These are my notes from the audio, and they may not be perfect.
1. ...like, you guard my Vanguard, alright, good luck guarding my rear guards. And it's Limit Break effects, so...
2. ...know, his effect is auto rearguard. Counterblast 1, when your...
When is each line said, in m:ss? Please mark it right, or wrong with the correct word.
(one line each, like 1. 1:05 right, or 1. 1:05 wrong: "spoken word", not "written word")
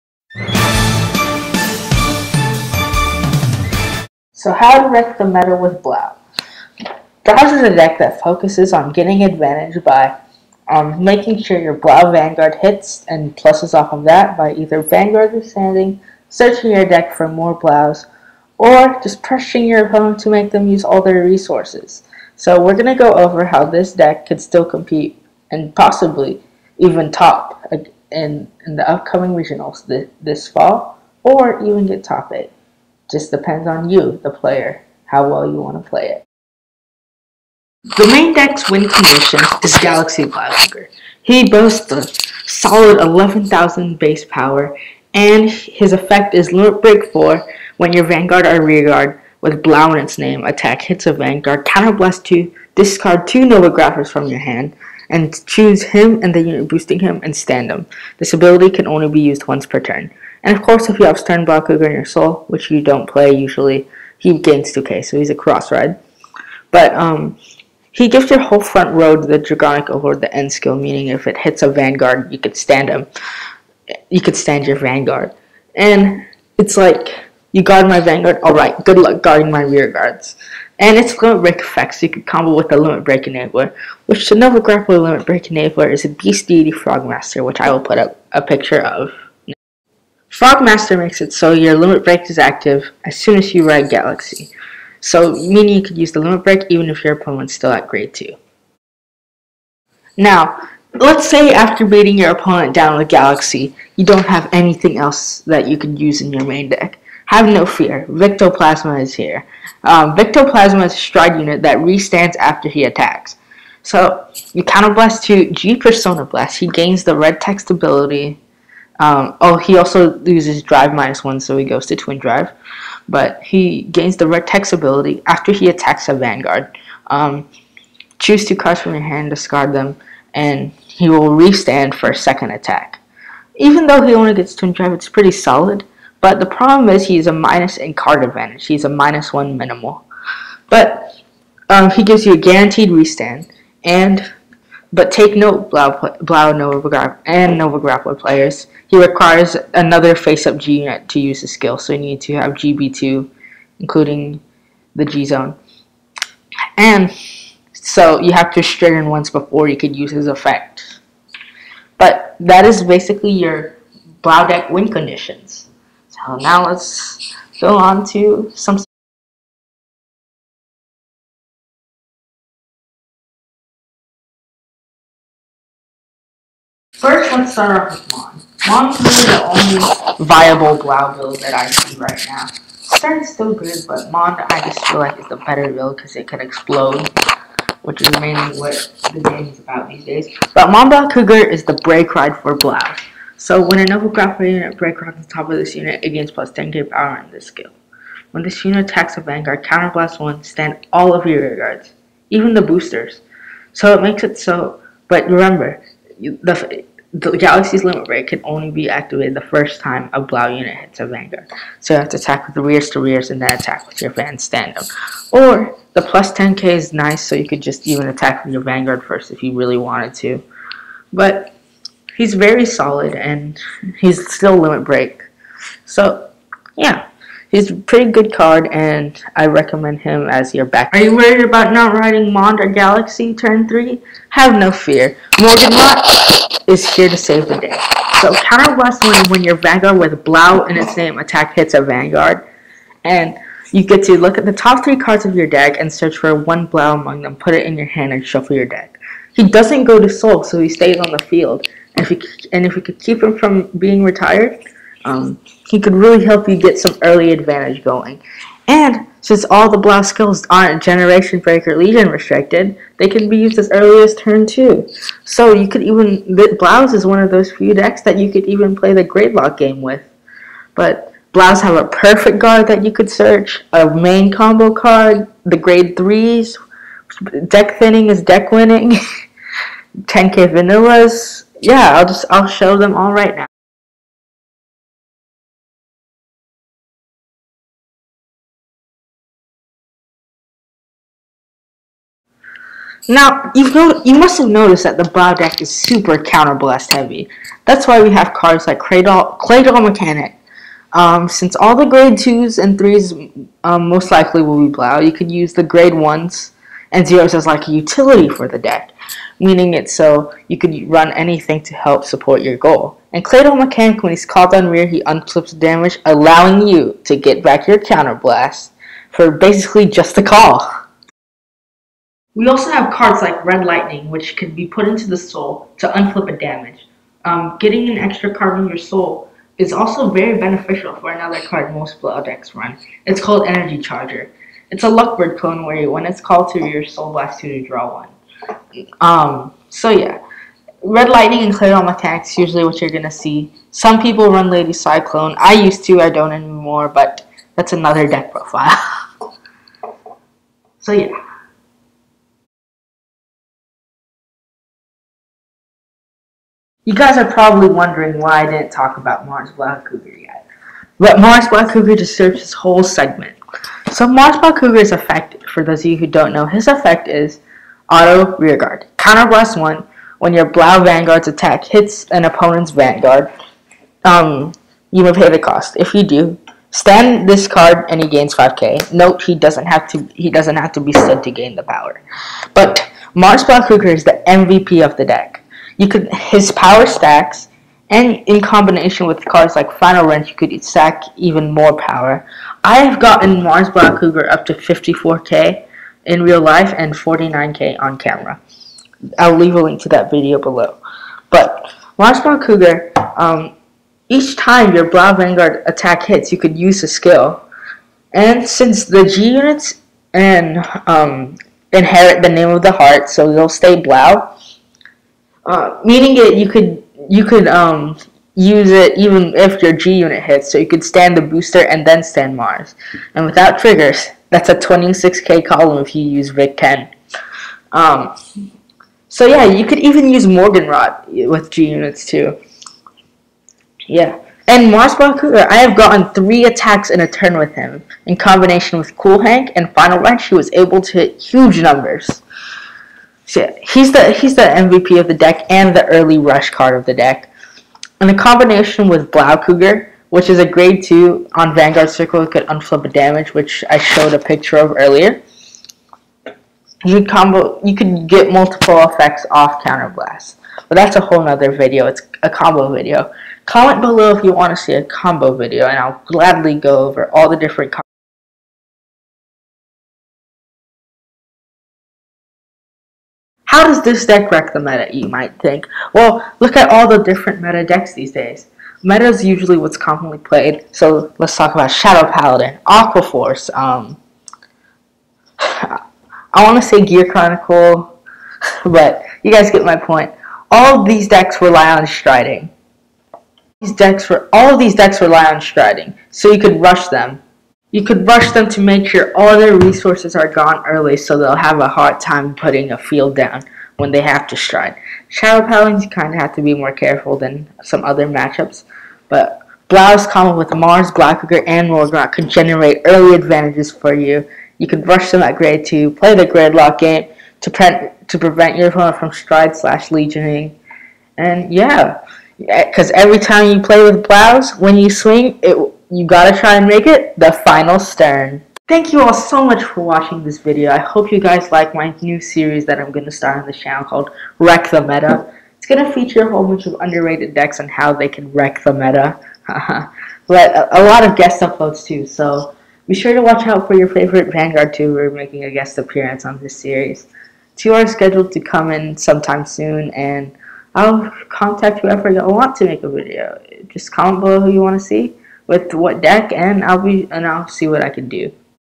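1. 1:16 right
2. 6:06 right.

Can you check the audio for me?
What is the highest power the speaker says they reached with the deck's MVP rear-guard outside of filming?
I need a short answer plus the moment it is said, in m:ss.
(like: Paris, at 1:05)
54k, at 6:34.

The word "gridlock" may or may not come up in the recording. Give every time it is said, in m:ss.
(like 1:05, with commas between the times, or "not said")
4:29, 8:36.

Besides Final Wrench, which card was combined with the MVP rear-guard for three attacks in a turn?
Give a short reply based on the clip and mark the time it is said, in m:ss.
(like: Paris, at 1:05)
Cool Hank, at 7:18.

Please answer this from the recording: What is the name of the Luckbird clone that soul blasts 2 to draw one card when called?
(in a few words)
Energy Charger.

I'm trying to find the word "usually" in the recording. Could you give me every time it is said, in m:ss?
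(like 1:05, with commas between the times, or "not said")
1:03, 5:42, 7:59.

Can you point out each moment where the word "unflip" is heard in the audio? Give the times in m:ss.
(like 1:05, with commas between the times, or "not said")
5:15, 5:25, 7:32.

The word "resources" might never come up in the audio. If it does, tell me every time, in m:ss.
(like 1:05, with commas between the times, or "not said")
0:21, 8:19.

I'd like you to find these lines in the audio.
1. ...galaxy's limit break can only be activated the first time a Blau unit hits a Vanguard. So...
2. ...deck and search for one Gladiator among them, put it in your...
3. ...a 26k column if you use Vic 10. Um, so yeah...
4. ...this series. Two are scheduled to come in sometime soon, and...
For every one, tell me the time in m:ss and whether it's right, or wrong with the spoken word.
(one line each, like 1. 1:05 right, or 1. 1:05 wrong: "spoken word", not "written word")
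1. 3:27 right
2. 4:05 wrong: "Blau", not "Gladiator"
3. 7:04 right
4. 9:06 right.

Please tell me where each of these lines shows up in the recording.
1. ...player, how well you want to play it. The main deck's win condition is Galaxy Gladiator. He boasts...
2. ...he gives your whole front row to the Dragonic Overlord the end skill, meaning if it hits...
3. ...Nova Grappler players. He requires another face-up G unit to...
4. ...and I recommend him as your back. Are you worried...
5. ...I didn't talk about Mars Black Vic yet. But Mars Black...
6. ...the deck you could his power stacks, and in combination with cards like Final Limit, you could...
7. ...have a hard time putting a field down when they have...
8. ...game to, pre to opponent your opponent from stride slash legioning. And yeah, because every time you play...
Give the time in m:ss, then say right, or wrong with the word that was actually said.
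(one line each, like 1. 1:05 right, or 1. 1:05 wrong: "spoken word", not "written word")
1. 0:34 right
2. 1:07 right
3. 2:27 right
4. 3:48 right
5. 5:58 wrong: "Cougar", not "Vic"
6. 6:24 wrong: "Wrench", not "Limit"
7. 8:21 right
8. 8:36 wrong: "prevent", not "opponent".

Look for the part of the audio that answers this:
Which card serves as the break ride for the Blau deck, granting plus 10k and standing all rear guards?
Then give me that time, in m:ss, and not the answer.
3:10.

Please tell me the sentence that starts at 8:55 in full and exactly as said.
It's gonna feature a whole bunch of underrated decks on how they can wreck the meta.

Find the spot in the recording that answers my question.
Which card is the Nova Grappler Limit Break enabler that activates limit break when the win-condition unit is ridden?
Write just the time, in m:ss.
1:26.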